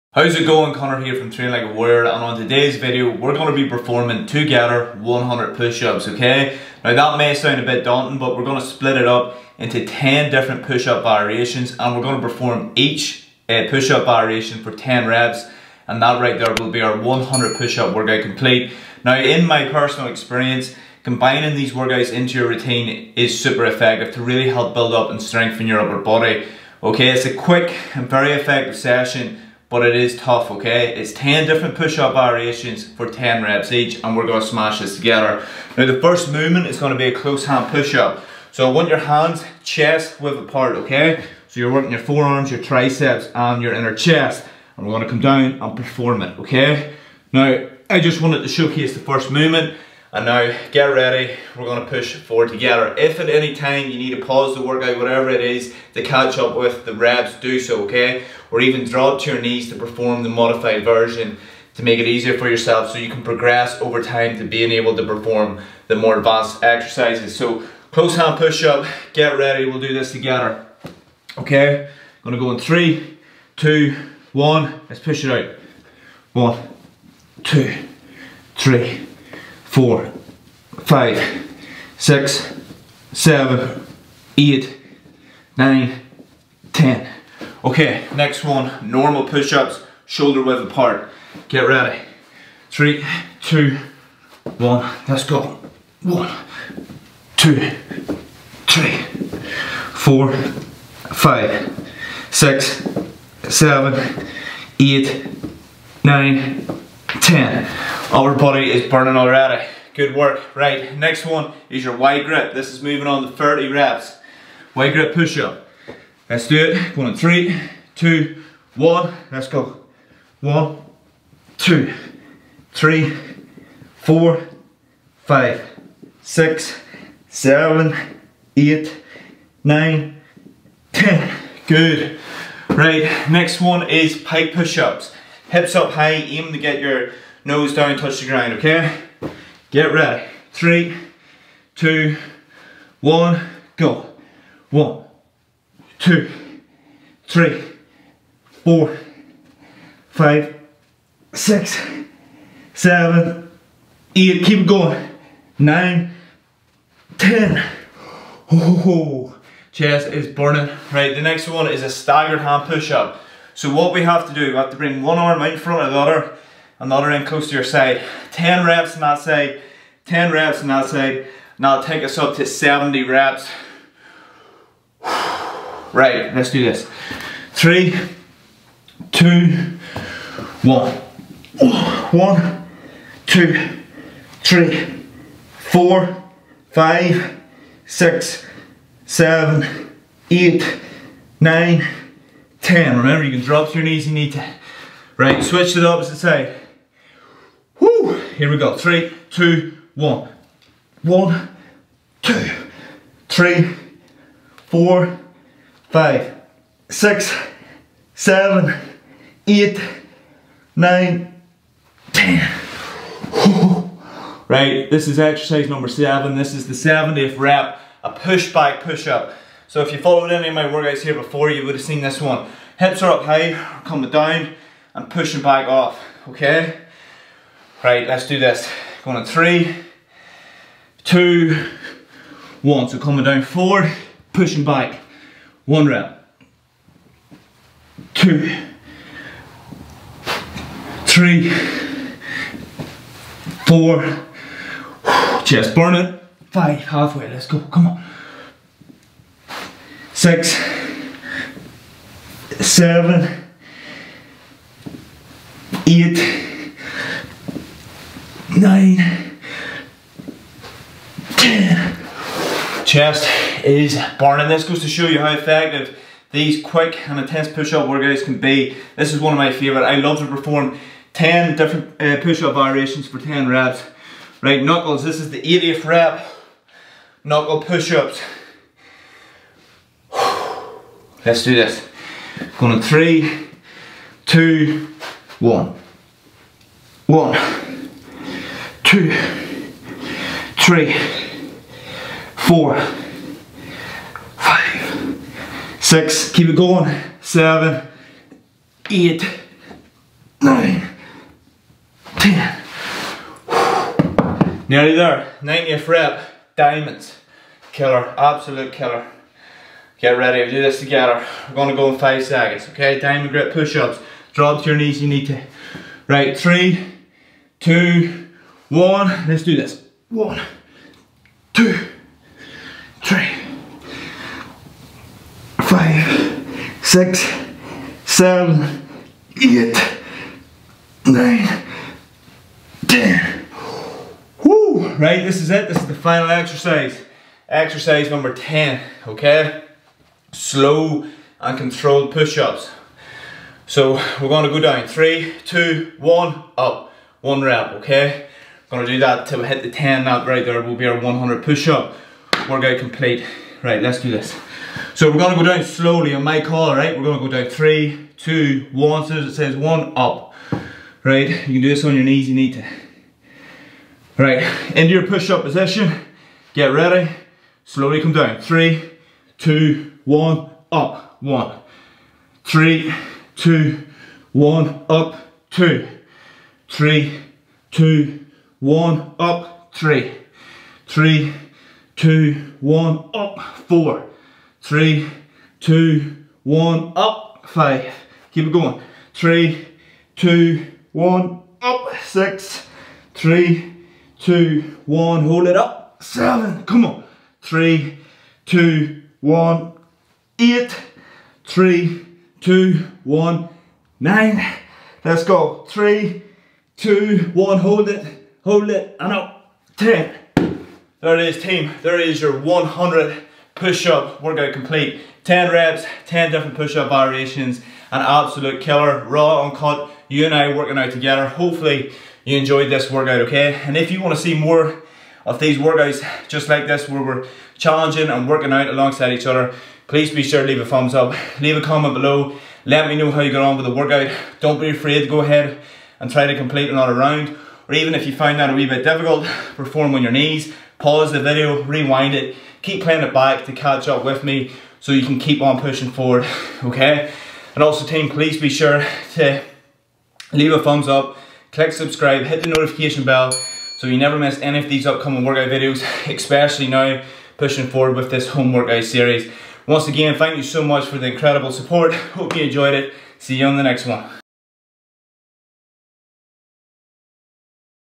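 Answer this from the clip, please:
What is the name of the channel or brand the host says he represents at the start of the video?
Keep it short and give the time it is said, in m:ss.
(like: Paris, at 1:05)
Train Like a Warrior, at 0:01.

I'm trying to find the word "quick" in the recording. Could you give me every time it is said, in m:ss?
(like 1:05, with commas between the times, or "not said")
0:27, 4:26.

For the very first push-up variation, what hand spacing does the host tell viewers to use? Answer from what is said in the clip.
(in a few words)
chest width.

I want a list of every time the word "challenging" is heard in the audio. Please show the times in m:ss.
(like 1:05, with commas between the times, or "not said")
7:07.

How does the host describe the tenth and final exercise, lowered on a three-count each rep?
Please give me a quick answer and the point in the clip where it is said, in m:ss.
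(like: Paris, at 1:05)
slow and controlled push-ups, at 5:40.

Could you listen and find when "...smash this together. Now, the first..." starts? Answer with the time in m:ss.
0:34.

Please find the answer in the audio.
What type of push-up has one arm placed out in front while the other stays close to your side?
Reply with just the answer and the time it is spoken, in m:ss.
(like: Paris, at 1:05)
staggered hand push-up, at 2:41.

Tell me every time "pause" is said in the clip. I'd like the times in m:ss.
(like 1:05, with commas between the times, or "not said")
0:54, 7:20.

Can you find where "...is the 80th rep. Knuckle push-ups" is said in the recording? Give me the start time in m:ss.
4:35.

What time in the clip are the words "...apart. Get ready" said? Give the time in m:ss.
1:30.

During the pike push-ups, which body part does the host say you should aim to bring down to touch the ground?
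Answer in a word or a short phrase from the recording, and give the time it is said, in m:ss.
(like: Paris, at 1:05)
nose, at 2:17.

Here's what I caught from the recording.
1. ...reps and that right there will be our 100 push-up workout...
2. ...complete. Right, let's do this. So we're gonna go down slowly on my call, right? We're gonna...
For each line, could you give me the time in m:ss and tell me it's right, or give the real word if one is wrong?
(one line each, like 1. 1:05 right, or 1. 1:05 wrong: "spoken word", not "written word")
1. 0:15 right
2. 5:52 right.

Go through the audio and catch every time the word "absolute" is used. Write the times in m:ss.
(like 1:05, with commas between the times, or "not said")
5:08, 6:58.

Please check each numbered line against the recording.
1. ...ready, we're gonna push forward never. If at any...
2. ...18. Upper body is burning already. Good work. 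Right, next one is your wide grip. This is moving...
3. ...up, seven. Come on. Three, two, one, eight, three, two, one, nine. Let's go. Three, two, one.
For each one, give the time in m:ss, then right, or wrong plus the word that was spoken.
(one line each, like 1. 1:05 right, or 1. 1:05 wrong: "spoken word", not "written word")
1. 0:50 wrong: "together", not "never"
2. 1:47 wrong: "10", not "18"
3. 6:35 right.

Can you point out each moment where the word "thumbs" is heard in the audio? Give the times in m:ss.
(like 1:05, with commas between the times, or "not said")
7:10, 7:30.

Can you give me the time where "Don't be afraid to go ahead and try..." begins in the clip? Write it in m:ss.
7:14.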